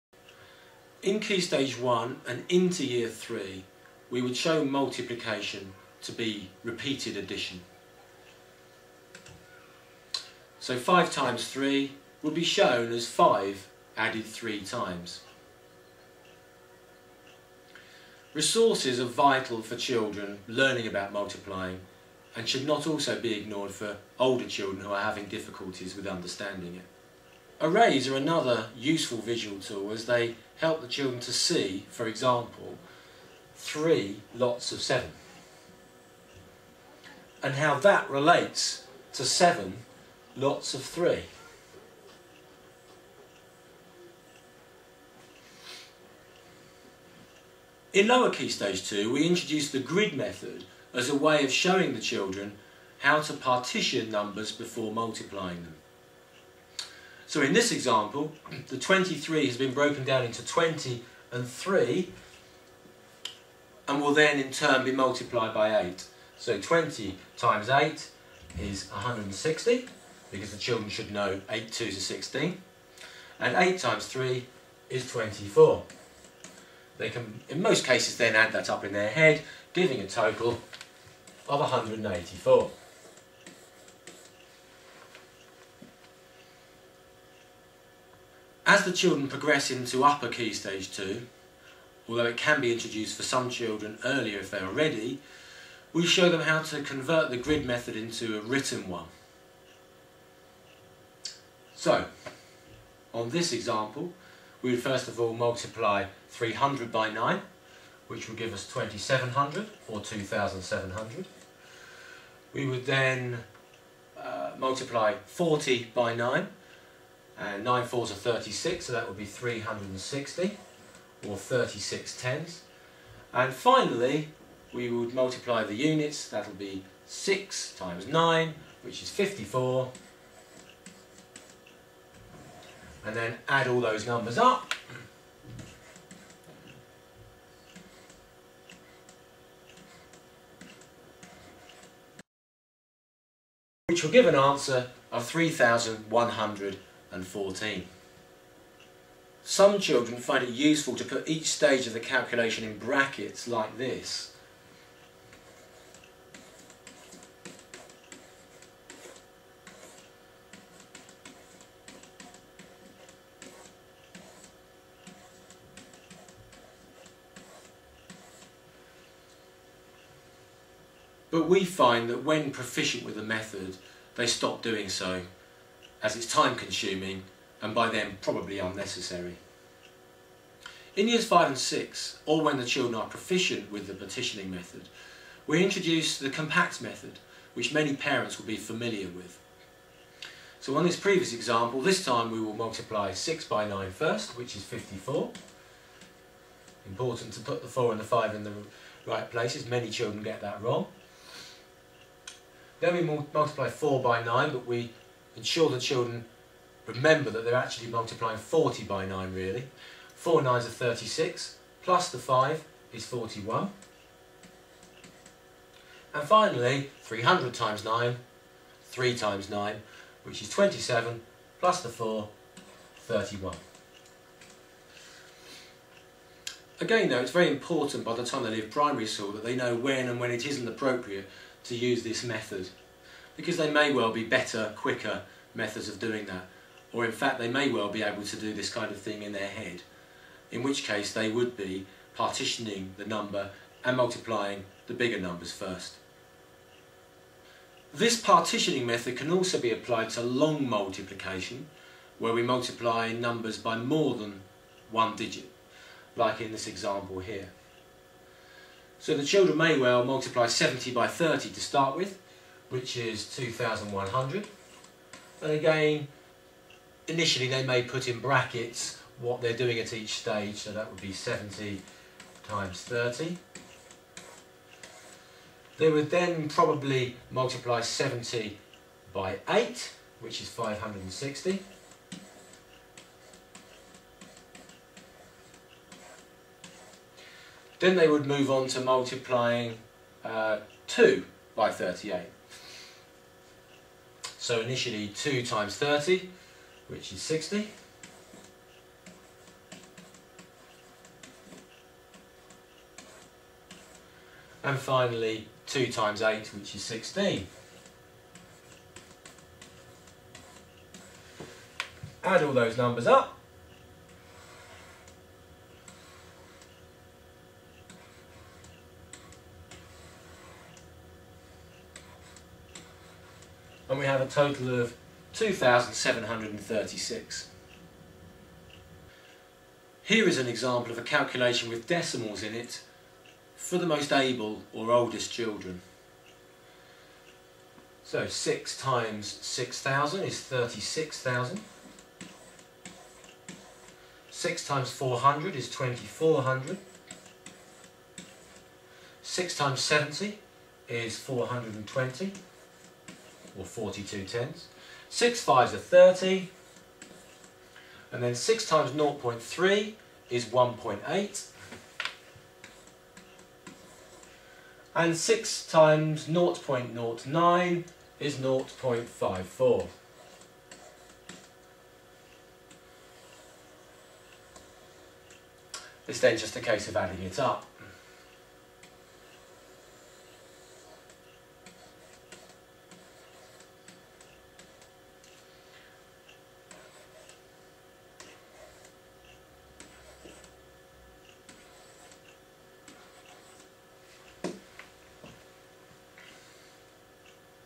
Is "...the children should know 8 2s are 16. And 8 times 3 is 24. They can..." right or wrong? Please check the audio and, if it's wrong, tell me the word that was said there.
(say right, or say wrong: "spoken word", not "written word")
right.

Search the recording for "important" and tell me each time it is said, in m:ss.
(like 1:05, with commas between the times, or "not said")
3:16, 3:47.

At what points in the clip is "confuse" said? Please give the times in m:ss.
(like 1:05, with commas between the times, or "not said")
not said.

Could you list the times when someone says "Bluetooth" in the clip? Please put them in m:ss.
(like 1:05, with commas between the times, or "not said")
not said.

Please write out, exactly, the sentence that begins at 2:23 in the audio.
which will give an answer of 3,100 and 14.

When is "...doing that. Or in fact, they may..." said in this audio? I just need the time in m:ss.
3:55.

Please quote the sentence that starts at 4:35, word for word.
They would then probably multiply 70 by 8, which is 560.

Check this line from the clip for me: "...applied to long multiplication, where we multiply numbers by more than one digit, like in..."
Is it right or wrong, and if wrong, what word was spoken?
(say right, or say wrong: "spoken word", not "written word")
right.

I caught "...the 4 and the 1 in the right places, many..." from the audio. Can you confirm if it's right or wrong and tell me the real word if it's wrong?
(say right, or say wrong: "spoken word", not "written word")
wrong: "5", not "1".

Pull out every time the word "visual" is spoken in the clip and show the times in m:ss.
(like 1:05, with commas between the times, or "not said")
0:29.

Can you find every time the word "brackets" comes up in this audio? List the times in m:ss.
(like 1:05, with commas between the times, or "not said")
2:32, 4:28.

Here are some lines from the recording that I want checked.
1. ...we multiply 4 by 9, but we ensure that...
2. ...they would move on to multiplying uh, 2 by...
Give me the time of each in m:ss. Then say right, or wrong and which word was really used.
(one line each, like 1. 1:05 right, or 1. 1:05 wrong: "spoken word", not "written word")
1. 3:22 right
2. 4:47 right.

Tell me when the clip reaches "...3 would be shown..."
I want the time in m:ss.
0:11.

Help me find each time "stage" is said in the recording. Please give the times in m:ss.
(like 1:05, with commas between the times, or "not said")
0:01, 0:48, 1:30, 2:31, 4:30.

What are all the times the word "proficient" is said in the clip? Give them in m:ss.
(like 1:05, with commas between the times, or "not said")
2:52, 3:03.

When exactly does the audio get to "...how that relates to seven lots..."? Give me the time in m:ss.
0:37.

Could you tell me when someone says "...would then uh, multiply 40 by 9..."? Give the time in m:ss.
1:52.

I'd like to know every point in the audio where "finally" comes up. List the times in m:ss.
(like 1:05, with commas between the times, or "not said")
2:03, 3:36, 5:04.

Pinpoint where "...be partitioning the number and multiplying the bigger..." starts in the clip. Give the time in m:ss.
4:01.